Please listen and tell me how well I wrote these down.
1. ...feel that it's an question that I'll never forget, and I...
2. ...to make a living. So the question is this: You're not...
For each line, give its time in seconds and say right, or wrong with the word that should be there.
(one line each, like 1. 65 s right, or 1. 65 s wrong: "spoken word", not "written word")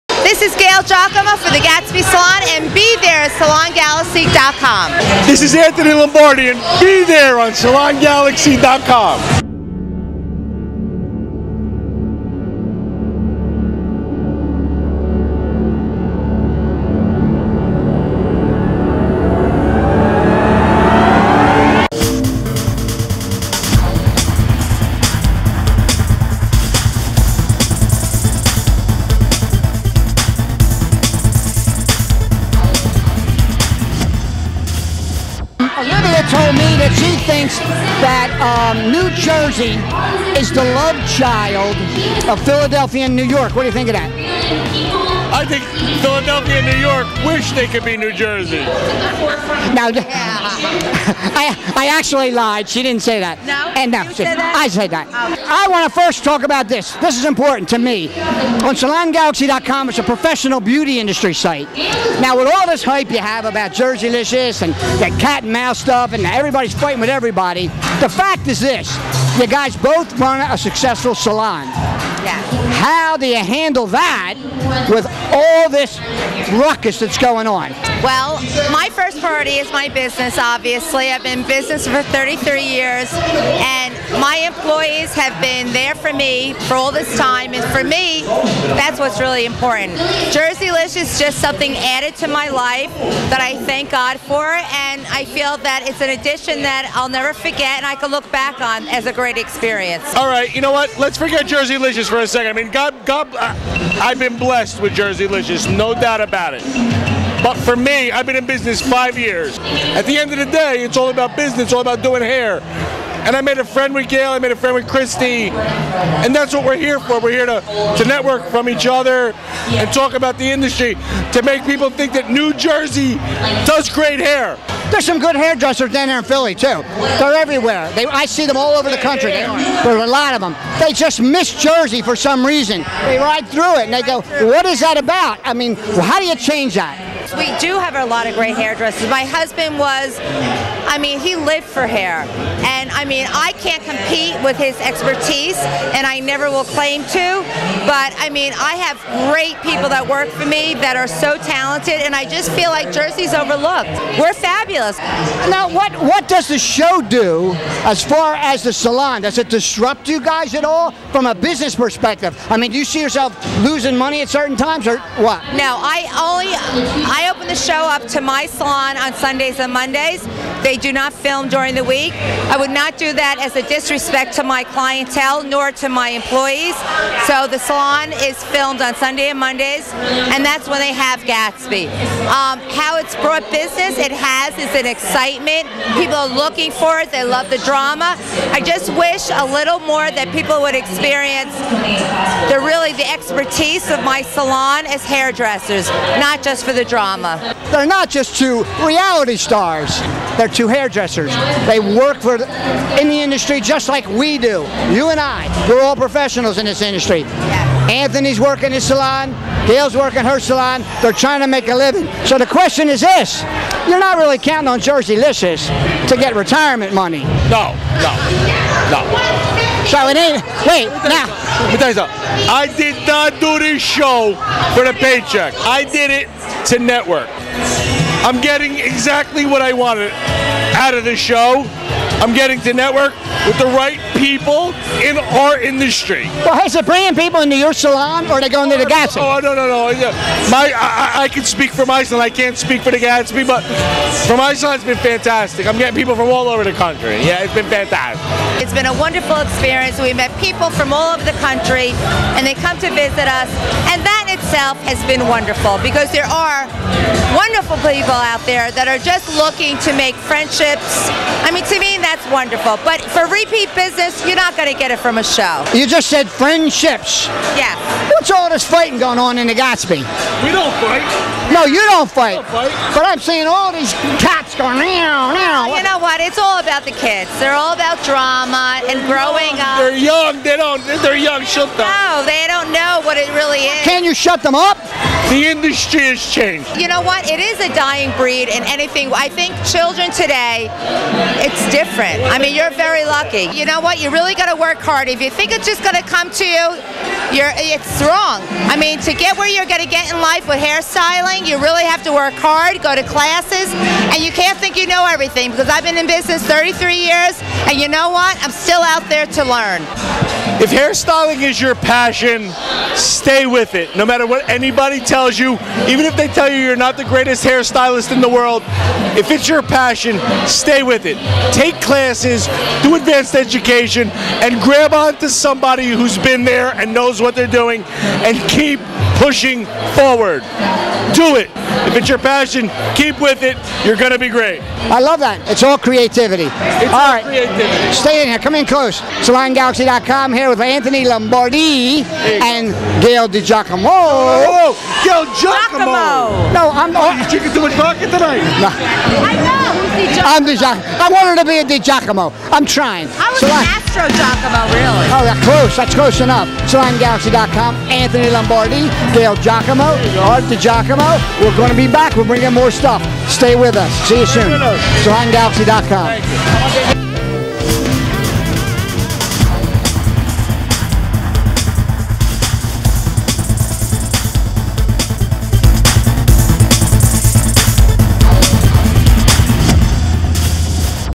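1. 95 s wrong: "addition", not "question"
2. 211 s right.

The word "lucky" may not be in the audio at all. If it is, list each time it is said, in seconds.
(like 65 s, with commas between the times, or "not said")
293 s.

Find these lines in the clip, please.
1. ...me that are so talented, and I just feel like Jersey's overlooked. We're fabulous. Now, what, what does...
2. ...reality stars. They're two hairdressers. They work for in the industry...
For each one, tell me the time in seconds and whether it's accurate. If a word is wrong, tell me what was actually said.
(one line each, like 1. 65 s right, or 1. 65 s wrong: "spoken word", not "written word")
1. 150 s right
2. 198 s right.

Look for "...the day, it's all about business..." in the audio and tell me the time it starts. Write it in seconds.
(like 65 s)
110 s.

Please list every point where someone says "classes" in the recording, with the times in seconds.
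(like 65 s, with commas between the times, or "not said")
303 s, 321 s.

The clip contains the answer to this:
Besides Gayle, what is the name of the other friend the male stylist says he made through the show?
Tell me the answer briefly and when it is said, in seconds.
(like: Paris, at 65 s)
Christy, at 114 s.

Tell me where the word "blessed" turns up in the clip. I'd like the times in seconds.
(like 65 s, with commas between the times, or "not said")
104 s.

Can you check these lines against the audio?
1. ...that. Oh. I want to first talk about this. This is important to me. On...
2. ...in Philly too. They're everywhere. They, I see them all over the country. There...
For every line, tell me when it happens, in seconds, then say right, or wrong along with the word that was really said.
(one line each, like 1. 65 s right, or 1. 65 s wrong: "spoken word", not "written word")
1. 54 s right
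2. 126 s right.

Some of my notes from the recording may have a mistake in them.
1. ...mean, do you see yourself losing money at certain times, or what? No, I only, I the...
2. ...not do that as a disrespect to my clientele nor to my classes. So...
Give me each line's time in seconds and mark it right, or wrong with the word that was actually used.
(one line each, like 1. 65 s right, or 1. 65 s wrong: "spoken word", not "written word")
1. 162 s right
2. 172 s wrong: "employees", not "classes".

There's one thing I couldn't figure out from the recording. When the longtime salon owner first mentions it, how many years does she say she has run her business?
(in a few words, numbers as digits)
33.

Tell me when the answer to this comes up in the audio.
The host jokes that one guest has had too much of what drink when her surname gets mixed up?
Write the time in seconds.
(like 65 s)
347 s.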